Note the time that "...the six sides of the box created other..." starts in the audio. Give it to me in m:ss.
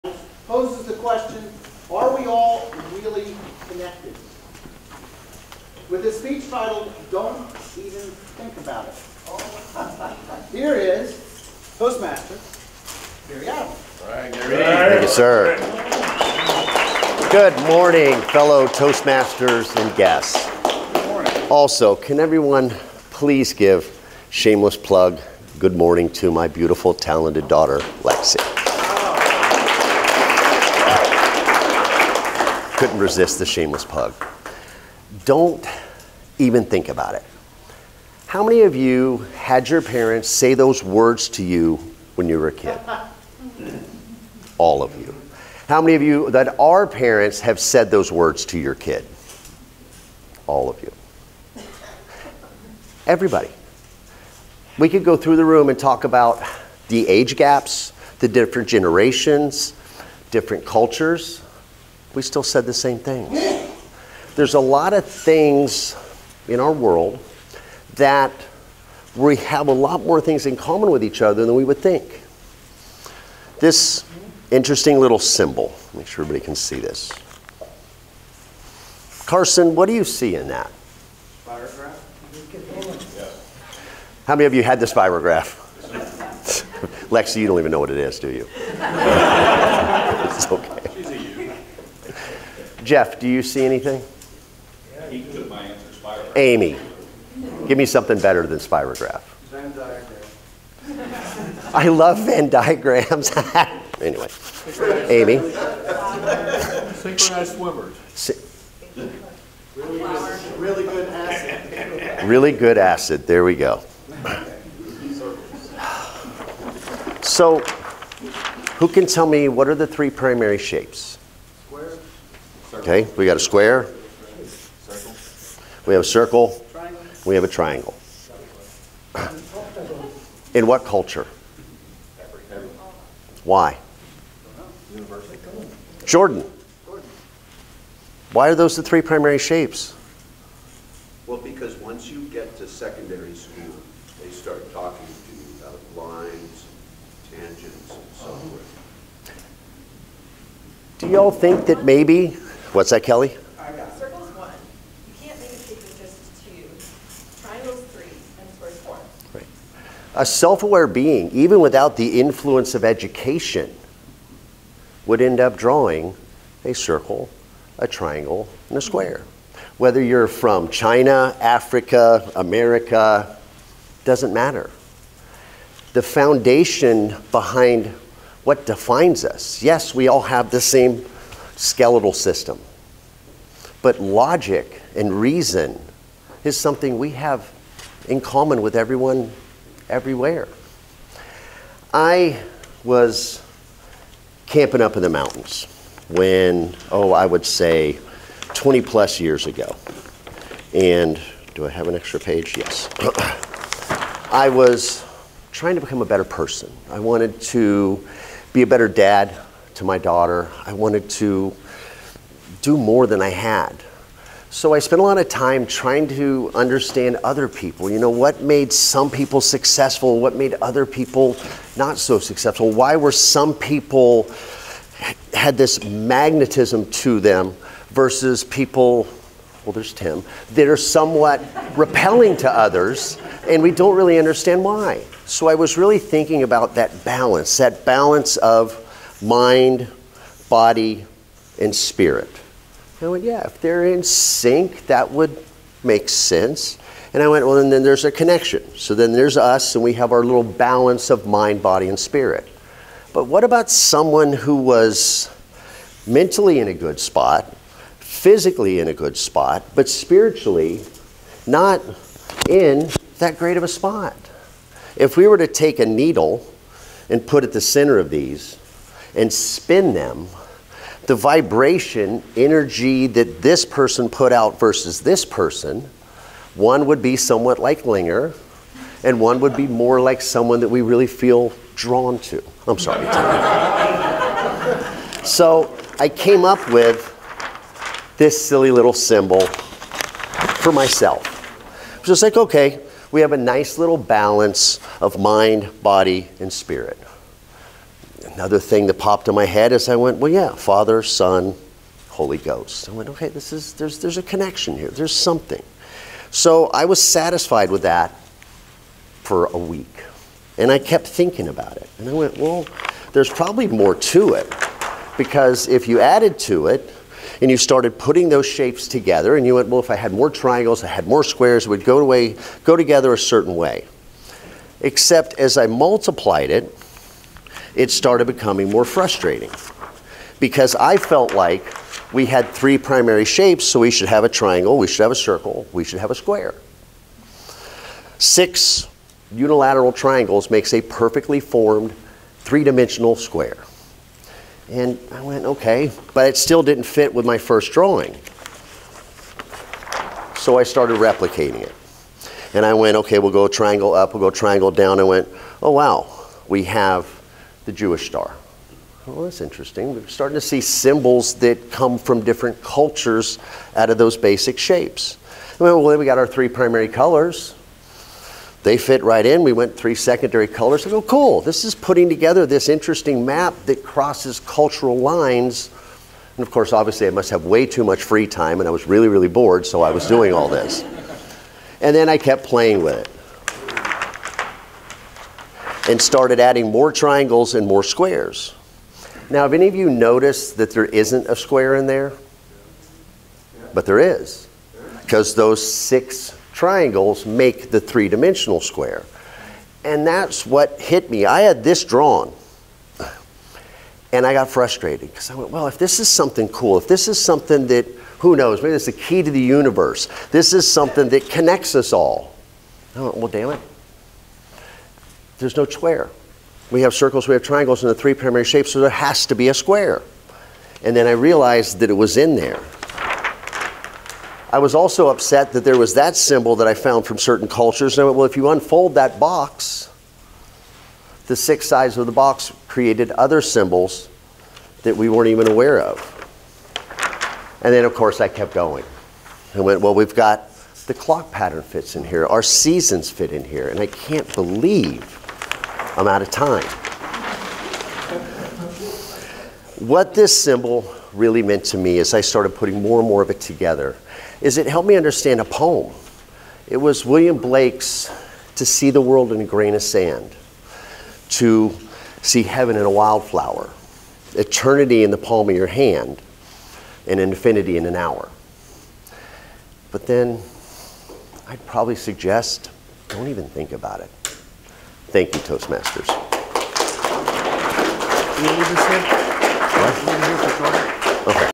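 7:11.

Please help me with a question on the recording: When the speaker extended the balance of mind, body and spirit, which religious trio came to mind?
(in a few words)
Father, Son, Holy Ghost.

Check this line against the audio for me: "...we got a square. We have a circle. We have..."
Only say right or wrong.
right.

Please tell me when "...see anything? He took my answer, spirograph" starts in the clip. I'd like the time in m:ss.
1:33.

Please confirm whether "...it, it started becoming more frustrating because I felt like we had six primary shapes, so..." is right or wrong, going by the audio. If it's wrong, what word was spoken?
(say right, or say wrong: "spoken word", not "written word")
wrong: "three", not "six".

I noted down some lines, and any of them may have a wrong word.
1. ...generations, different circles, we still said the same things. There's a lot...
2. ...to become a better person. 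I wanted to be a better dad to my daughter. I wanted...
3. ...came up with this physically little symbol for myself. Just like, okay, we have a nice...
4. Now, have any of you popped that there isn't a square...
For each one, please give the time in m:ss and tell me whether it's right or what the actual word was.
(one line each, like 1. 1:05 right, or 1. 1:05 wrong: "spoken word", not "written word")
1. 0:58 wrong: "cultures", not "circles"
2. 3:25 right
3. 4:46 wrong: "silly", not "physically"
4. 6:29 wrong: "noticed", not "popped".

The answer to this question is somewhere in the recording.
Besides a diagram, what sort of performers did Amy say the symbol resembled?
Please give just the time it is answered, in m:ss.
1:46.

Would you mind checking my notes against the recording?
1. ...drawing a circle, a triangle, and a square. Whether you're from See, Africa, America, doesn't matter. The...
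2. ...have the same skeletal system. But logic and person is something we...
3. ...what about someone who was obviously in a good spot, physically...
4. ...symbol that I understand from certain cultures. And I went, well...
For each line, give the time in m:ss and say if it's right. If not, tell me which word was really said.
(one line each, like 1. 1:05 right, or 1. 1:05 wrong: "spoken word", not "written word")
1. 2:45 wrong: "China", not "See"
2. 3:00 wrong: "reason", not "person"
3. 4:13 wrong: "mentally", not "obviously"
4. 7:06 wrong: "found", not "understand".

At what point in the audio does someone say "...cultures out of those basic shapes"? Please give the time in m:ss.
6:02.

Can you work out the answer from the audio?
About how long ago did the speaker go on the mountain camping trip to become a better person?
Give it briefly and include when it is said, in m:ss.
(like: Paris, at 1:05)
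20 plus years, at 3:18.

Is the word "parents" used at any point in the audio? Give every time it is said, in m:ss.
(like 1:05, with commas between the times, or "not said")
0:39, 0:46.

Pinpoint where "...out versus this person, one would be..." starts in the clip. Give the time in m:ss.
4:34.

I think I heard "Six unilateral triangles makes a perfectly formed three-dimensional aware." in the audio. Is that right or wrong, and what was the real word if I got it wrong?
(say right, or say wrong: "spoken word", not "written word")
wrong: "square", not "aware".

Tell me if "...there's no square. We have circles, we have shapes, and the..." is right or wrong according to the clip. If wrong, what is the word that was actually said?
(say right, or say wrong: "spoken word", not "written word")
wrong: "triangles", not "shapes".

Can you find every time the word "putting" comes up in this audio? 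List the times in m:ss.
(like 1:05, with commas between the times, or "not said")
5:17, 6:11, 7:32.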